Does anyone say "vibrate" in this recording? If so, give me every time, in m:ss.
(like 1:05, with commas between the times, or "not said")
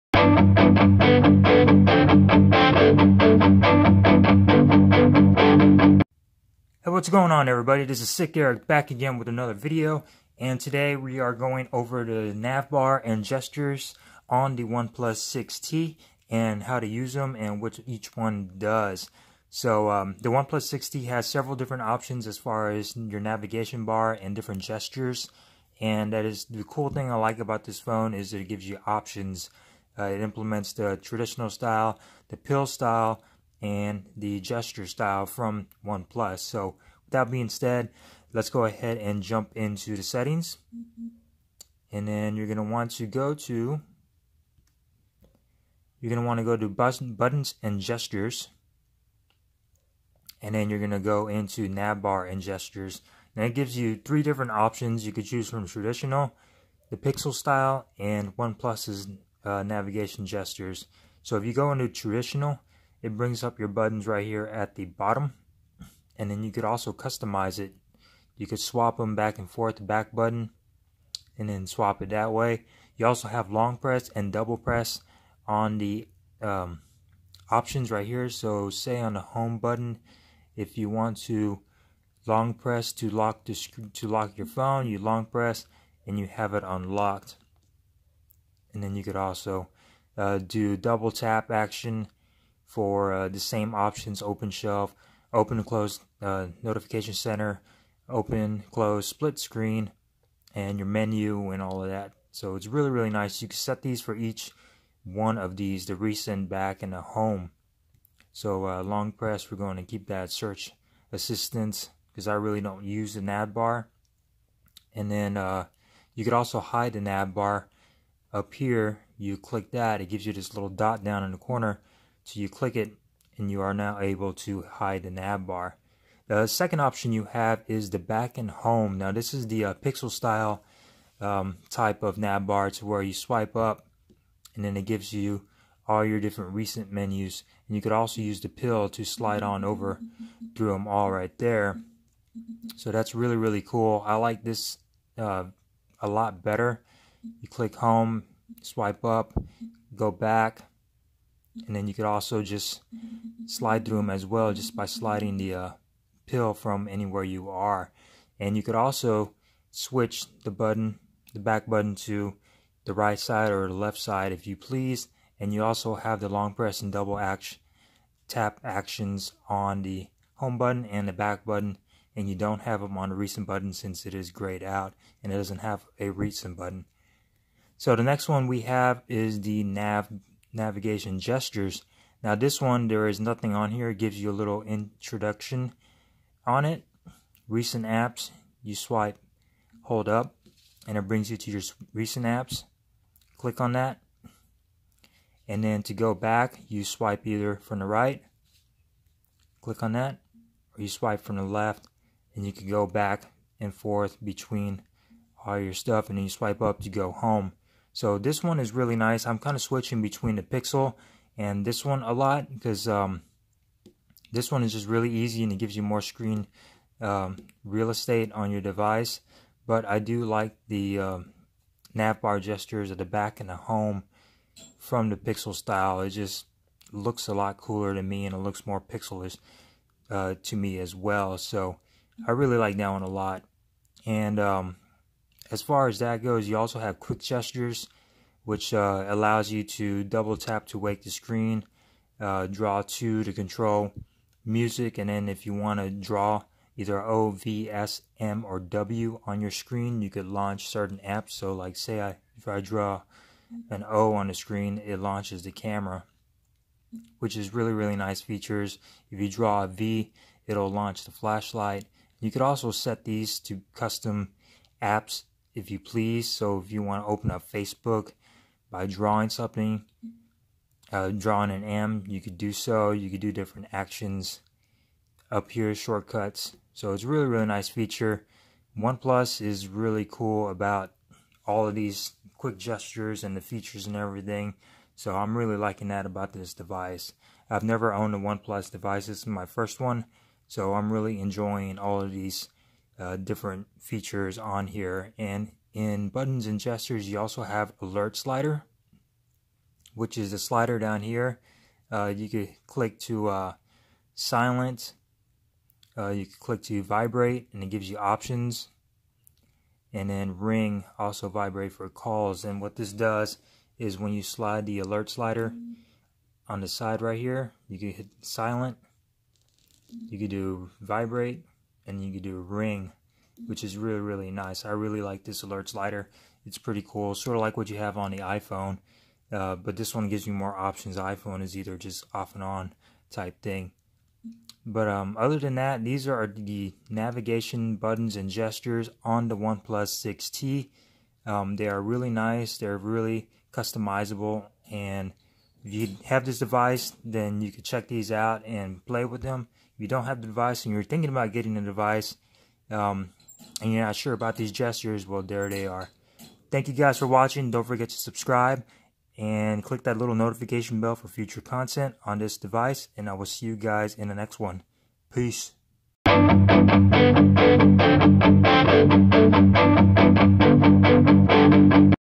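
5:06, 5:11, 5:20.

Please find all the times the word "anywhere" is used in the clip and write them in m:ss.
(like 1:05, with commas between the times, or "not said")
2:36.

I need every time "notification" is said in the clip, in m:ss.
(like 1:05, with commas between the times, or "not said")
1:36, 6:00.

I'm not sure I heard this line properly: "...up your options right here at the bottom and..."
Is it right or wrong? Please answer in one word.
wrong.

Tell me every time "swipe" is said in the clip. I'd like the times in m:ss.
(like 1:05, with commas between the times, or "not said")
2:13, 2:28, 3:08, 3:16, 3:20, 3:26.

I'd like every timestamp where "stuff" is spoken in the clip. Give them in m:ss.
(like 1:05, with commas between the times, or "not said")
3:25.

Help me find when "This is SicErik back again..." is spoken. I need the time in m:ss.
0:07.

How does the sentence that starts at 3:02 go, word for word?
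Now this one, there is nothing on here.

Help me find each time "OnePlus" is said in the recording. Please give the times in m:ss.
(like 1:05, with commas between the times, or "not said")
0:14, 0:20, 0:35, 0:58, 4:38, 4:48, 5:39.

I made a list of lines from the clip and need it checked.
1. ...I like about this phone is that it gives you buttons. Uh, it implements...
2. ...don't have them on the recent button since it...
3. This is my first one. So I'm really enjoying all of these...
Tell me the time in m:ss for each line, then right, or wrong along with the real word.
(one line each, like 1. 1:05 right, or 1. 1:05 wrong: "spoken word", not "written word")
1. 0:27 wrong: "options", not "buttons"
2. 2:52 right
3. 4:49 right.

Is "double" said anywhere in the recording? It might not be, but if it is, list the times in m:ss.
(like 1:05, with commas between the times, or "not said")
1:14, 1:30, 2:46, 4:00.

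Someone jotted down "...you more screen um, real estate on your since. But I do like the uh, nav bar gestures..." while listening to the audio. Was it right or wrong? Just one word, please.
wrong.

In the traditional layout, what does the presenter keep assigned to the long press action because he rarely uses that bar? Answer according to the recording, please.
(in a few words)
Search assistance.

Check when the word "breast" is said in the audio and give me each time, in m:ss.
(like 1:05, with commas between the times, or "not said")
not said.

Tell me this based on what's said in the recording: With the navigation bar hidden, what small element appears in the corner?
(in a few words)
Little dot.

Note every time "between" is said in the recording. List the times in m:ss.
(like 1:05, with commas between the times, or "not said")
3:24, 3:30.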